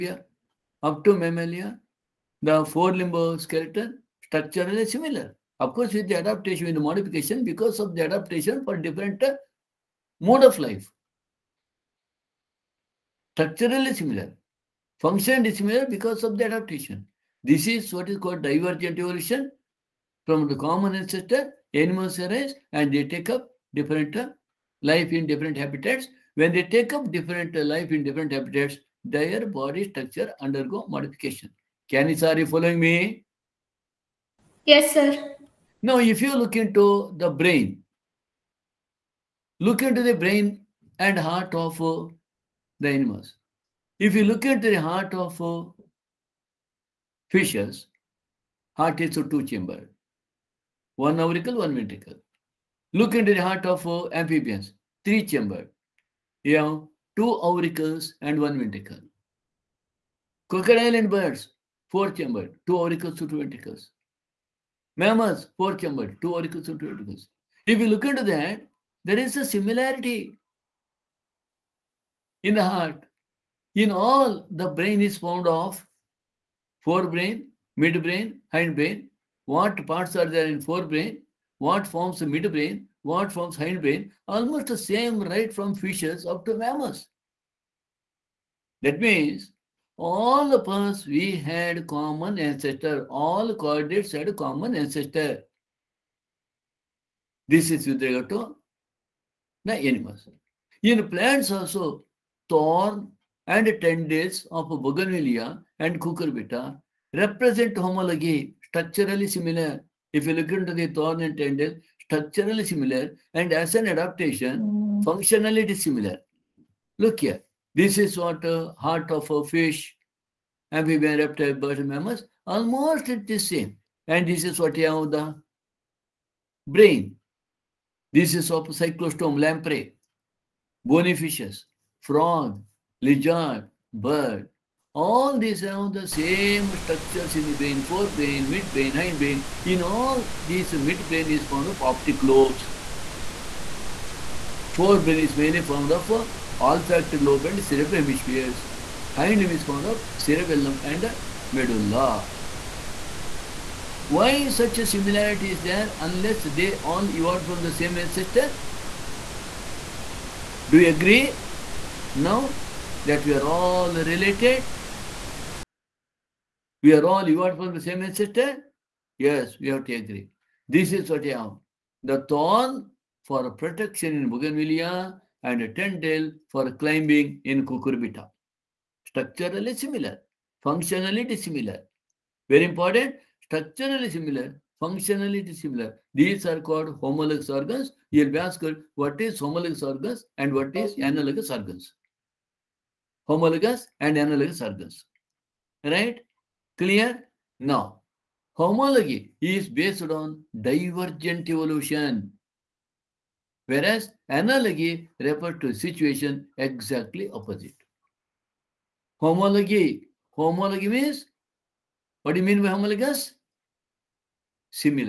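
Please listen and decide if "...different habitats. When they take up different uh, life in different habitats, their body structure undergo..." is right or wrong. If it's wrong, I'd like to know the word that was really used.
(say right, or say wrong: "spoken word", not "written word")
right.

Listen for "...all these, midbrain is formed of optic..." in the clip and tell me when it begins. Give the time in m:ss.
2:19.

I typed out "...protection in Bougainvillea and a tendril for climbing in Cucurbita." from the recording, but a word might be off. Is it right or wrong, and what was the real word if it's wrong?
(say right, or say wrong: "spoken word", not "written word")
right.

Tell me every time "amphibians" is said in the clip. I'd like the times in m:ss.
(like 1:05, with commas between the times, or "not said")
0:54, 2:00.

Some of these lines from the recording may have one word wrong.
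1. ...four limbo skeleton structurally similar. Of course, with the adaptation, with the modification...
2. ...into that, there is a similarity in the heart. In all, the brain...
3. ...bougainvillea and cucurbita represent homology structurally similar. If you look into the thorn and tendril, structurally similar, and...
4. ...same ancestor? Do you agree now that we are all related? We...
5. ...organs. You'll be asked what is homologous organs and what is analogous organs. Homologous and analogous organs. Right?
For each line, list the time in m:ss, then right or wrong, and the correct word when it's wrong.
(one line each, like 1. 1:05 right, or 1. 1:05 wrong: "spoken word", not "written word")
1. 0:02 right
2. 1:08 right
3. 1:44 right
4. 2:37 right
5. 3:07 right.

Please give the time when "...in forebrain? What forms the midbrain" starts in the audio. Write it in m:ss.
1:20.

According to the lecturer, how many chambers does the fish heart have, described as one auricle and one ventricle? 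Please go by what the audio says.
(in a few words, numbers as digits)
2.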